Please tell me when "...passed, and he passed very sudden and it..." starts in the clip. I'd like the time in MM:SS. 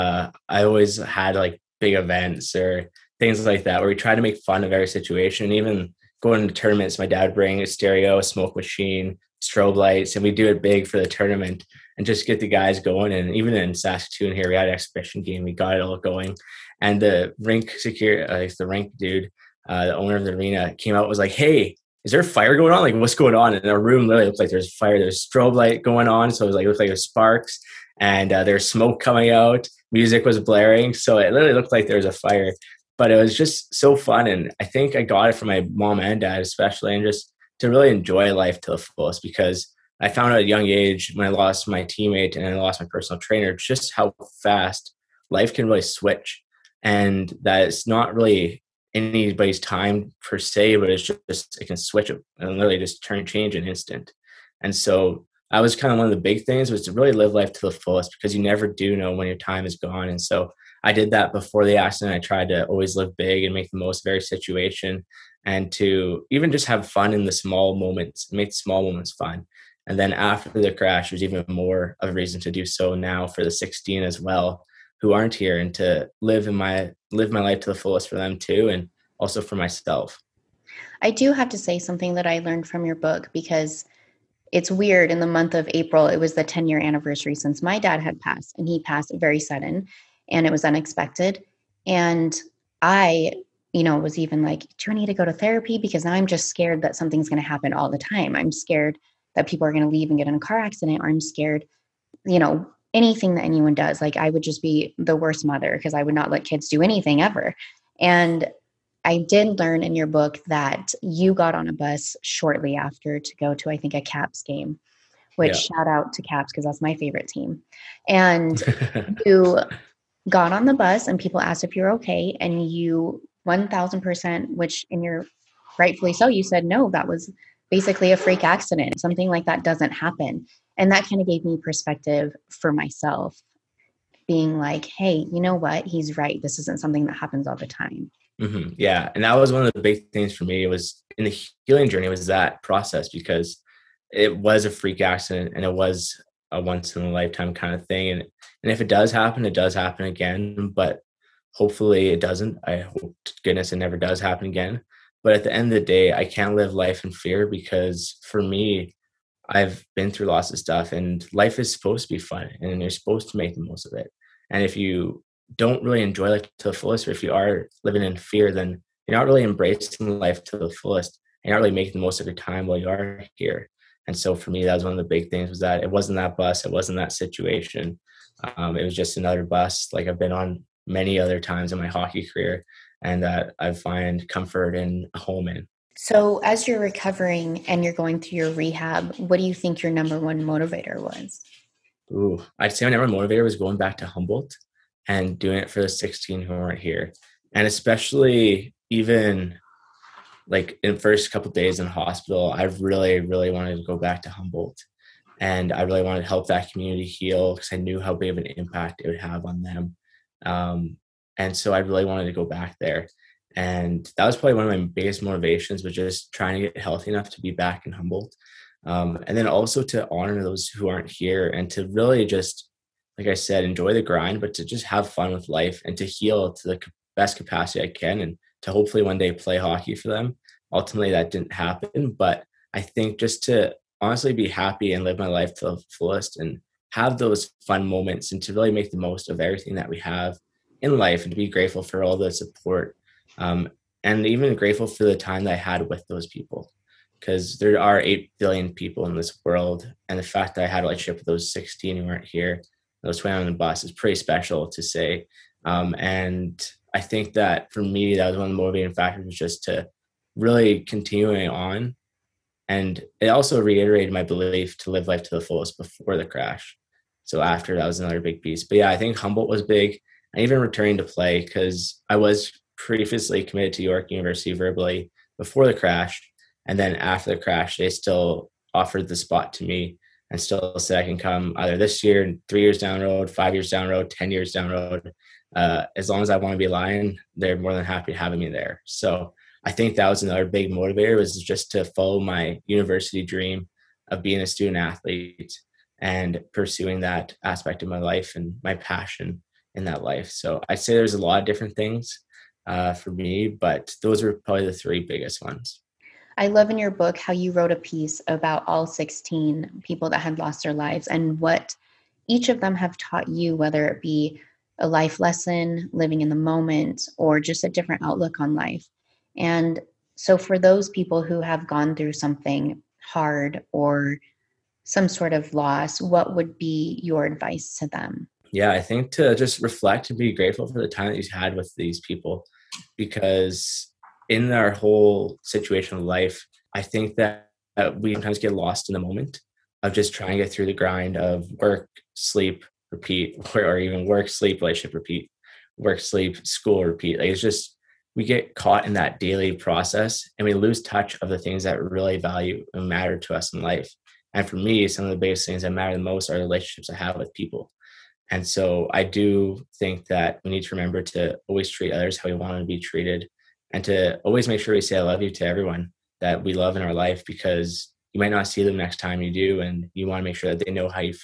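01:28.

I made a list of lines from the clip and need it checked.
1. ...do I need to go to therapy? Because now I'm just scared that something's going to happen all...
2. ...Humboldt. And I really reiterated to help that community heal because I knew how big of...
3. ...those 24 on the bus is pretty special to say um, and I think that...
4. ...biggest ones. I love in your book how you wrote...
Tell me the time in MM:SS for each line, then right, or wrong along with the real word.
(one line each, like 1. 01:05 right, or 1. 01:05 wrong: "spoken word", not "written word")
1. 01:34 right
2. 03:24 wrong: "wanted", not "reiterated"
3. 04:13 wrong: "20", not "24"
4. 05:04 right.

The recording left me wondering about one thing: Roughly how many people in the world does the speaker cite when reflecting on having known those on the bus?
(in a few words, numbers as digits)
8 billion.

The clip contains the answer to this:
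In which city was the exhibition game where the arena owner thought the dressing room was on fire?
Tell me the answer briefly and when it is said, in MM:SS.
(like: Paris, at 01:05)
Saskatoon, at 00:13.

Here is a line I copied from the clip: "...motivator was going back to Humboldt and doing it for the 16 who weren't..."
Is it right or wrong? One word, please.
right.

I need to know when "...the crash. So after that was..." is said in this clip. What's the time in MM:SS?
04:26.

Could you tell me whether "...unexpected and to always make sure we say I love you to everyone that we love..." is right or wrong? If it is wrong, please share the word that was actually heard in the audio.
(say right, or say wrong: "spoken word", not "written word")
wrong: "treated", not "unexpected".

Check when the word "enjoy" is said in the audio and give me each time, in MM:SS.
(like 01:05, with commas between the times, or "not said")
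00:37, 02:46, 03:43.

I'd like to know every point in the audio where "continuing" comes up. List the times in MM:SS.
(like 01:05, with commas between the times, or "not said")
04:20.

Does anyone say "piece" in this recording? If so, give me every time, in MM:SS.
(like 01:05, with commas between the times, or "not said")
04:28, 05:07.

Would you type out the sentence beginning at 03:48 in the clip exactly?
And to hopefully one day play hockey for them.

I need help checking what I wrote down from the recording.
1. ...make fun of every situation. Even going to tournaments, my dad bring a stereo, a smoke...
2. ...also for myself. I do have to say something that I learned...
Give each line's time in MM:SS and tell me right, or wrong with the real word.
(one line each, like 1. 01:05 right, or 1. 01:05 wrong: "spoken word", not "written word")
1. 00:04 right
2. 01:19 right.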